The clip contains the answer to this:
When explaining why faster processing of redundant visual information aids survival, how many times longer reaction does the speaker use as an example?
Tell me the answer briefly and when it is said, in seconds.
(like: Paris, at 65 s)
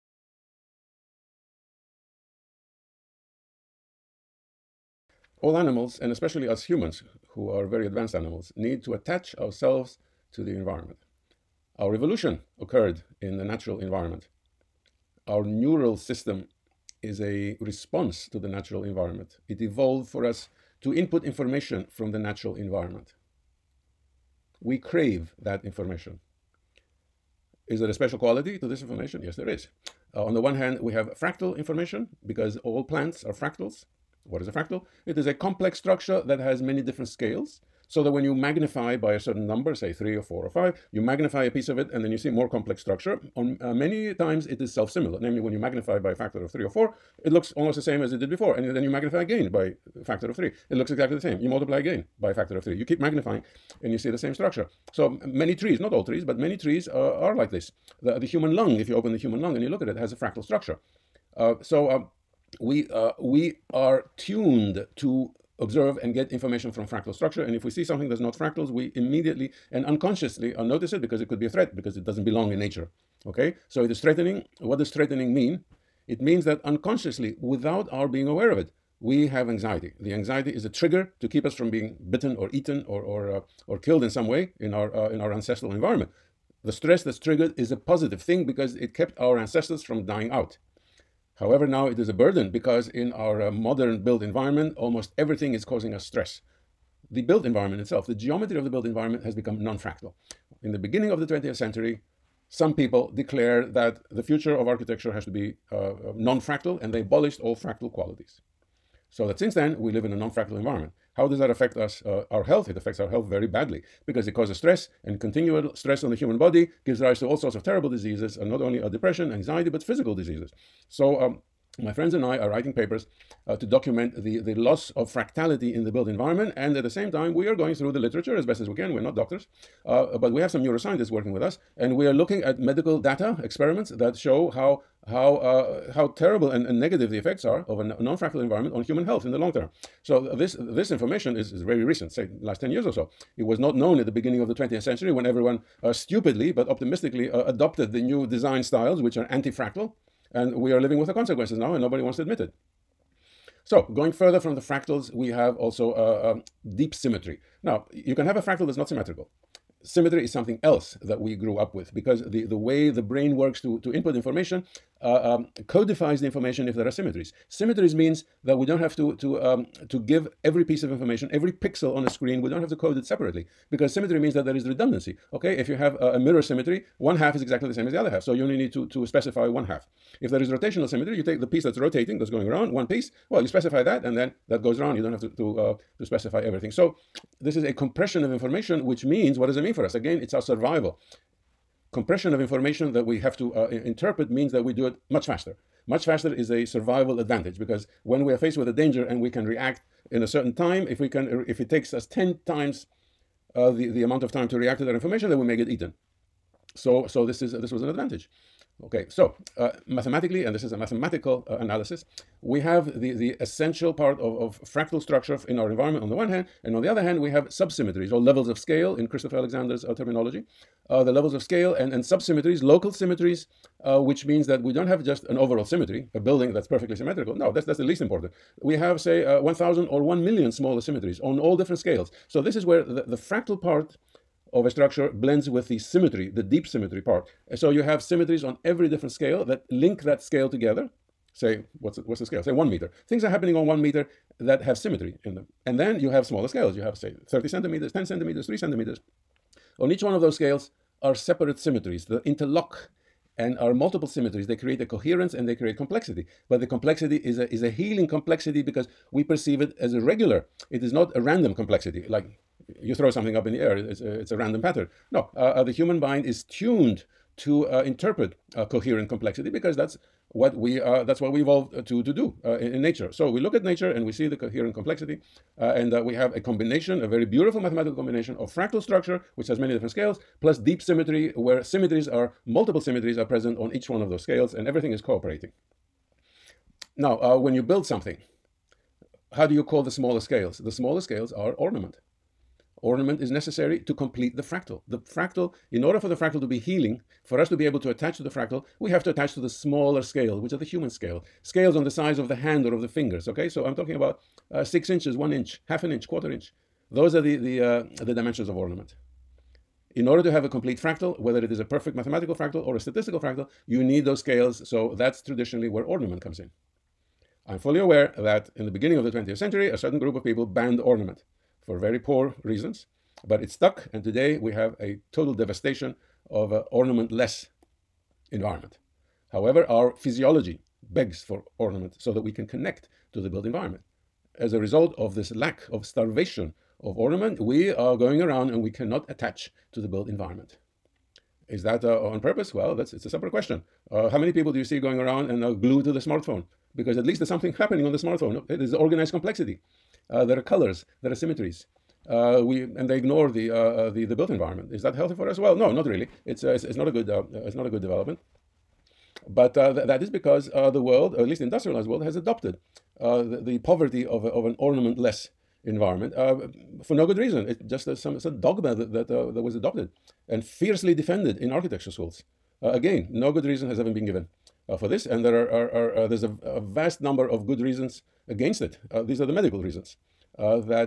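10 times, at 202 s.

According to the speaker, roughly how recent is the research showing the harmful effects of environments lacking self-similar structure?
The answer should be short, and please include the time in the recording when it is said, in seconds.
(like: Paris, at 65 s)
Last 10 years, at 142 s.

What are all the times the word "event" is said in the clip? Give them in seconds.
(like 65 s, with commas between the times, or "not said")
not said.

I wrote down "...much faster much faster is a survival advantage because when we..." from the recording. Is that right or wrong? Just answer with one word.
right.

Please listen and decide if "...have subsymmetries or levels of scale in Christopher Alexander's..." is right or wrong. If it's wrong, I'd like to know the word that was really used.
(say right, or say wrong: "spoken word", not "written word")
right.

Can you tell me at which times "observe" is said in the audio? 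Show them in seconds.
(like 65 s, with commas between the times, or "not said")
65 s.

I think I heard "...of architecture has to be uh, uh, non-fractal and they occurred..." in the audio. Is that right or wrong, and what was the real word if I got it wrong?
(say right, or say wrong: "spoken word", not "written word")
wrong: "abolished", not "occurred".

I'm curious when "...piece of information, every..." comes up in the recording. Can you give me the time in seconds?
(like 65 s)
170 s.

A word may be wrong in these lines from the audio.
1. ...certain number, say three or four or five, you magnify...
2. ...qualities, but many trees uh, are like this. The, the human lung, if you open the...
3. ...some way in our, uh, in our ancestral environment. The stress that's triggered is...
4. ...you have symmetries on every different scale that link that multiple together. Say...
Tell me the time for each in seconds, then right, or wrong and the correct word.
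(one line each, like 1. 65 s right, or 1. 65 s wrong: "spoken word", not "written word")
1. 39 s right
2. 56 s wrong: "trees", not "qualities"
3. 84 s right
4. 237 s wrong: "scale", not "multiple".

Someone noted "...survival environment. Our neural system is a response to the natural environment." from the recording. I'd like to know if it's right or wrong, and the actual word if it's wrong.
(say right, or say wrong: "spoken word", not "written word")
wrong: "natural", not "survival".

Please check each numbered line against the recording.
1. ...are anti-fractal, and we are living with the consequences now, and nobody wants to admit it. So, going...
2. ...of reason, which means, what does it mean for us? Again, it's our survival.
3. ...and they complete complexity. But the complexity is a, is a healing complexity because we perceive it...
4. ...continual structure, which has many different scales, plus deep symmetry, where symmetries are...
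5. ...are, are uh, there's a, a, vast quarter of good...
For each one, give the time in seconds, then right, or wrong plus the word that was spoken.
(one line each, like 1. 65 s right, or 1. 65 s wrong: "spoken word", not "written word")
1. 149 s right
2. 188 s wrong: "information", not "reason"
3. 255 s wrong: "create", not "complete"
4. 278 s wrong: "fractal", not "continual"
5. 375 s wrong: "number", not "quarter".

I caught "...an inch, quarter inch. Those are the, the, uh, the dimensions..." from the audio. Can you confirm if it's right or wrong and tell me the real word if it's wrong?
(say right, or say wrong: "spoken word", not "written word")
right.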